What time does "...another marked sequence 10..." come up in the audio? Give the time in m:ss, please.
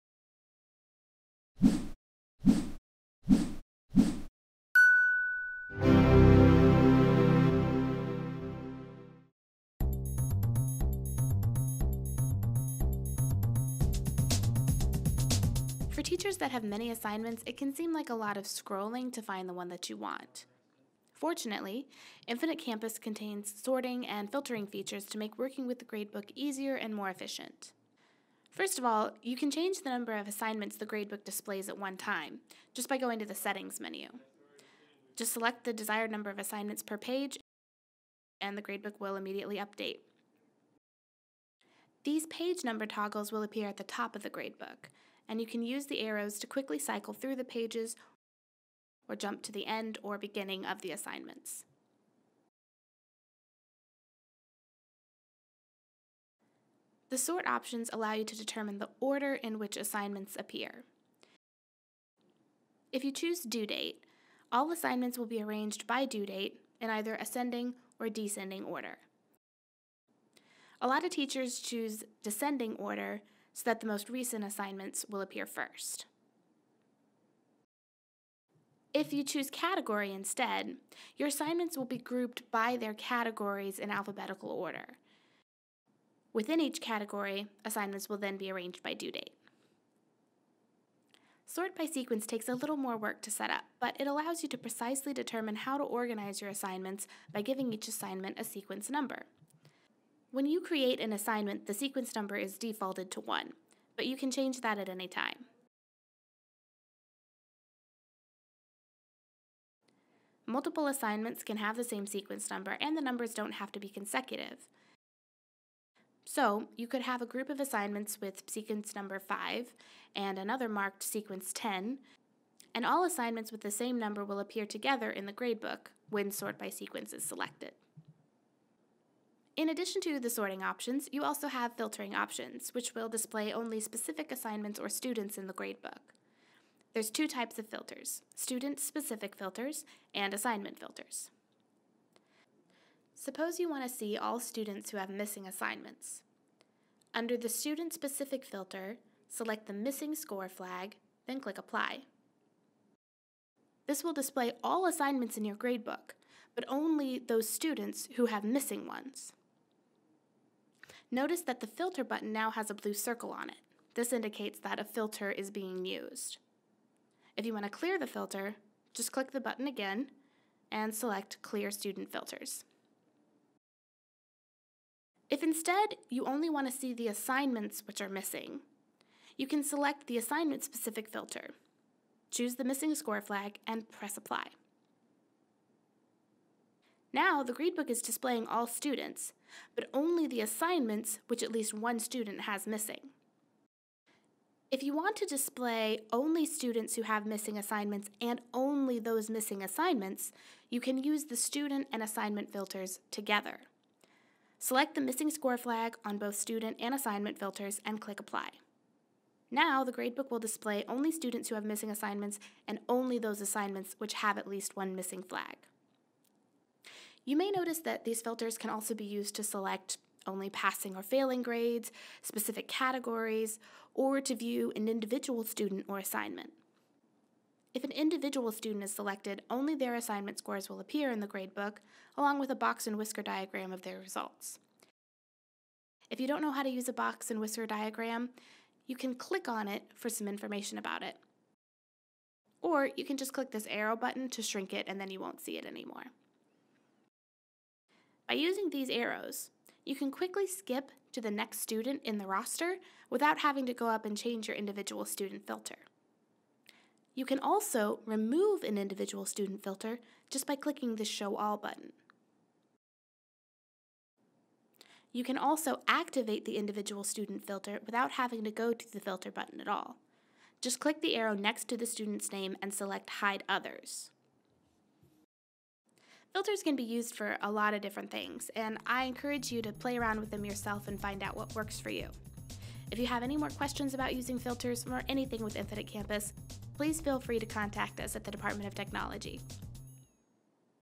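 2:00.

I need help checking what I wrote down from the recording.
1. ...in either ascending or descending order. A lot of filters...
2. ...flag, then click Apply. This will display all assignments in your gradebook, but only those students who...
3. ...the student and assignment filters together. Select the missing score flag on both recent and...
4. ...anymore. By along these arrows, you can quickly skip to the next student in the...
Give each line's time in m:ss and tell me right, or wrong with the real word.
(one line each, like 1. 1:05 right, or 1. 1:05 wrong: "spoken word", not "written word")
1. 1:06 wrong: "teachers", not "filters"
2. 2:30 right
3. 3:21 wrong: "student", not "recent"
4. 4:05 wrong: "using", not "along".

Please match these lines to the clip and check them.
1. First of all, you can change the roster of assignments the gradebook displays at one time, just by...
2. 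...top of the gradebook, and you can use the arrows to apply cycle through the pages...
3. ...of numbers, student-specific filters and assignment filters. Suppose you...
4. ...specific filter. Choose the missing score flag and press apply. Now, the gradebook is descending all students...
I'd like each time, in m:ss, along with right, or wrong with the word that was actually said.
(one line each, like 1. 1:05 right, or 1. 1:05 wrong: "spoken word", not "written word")
1. 0:28 wrong: "number", not "roster"
2. 0:43 wrong: "quickly", not "apply"
3. 2:17 wrong: "filters", not "numbers"
4. 3:00 wrong: "displaying", not "descending".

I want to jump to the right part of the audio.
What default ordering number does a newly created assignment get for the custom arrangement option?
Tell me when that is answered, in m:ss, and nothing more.
1:43.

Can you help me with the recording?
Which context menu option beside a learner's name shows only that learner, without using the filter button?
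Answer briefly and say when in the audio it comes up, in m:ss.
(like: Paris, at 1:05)
Hide Others, at 4:33.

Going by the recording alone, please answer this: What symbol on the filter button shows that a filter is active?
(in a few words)
blue circle.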